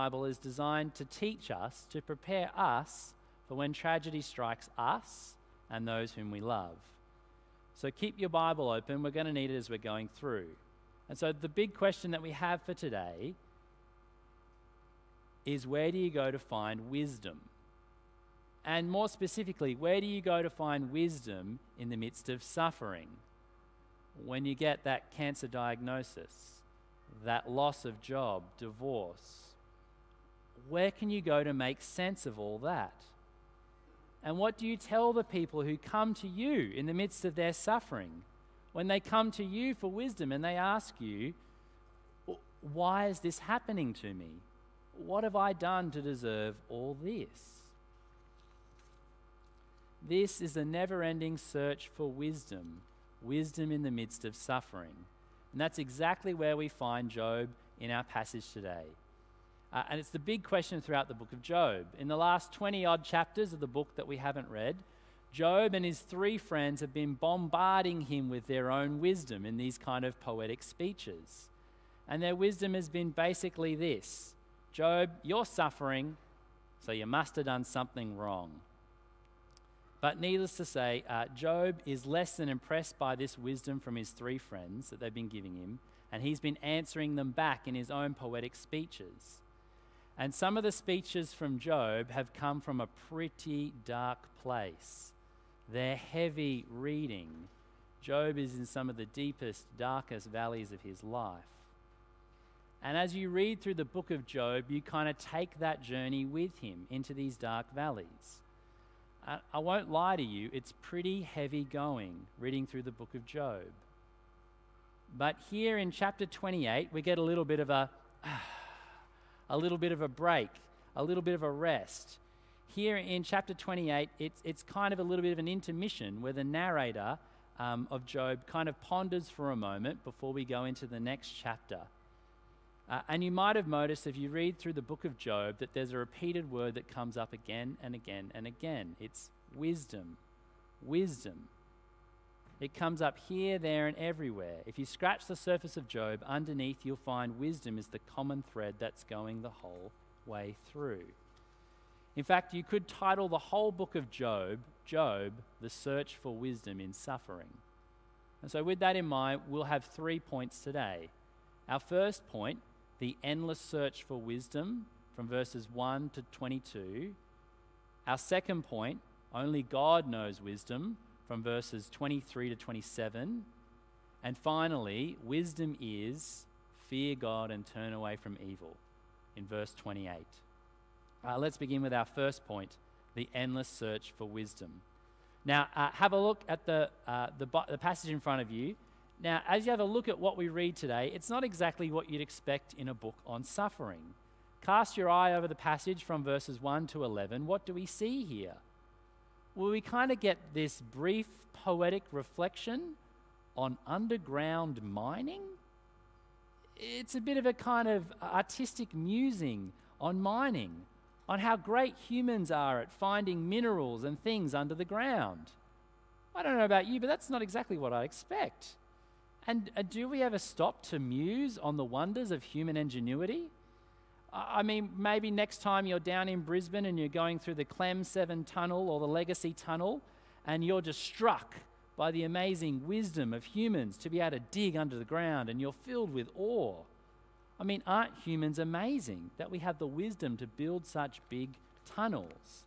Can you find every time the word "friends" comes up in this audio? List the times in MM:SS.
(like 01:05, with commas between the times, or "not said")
01:06, 01:24.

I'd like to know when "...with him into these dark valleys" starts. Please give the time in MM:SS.
01:46.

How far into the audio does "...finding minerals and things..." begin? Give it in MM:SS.
03:32.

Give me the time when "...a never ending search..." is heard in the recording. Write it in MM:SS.
00:50.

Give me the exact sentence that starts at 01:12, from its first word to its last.
And their wisdom has been basically this Job, you're suffering, so you must have done something wrong.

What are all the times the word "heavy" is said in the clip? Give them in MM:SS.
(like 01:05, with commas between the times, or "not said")
01:35, 01:51.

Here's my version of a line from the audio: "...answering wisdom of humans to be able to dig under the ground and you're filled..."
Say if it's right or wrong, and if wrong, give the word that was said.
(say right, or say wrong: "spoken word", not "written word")
wrong: "amazing", not "answering".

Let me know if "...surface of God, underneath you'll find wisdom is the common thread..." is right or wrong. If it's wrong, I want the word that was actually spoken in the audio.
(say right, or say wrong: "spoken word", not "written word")
wrong: "Job", not "God".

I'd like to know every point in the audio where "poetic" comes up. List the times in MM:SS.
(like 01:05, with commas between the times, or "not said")
01:10, 01:28, 03:21.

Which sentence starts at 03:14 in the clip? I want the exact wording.
Cast your eye over the passage from verses 1 to 11.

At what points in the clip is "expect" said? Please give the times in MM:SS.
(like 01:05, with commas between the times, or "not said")
03:12, 03:38.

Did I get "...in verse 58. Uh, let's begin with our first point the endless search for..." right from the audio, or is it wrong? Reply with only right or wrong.
wrong.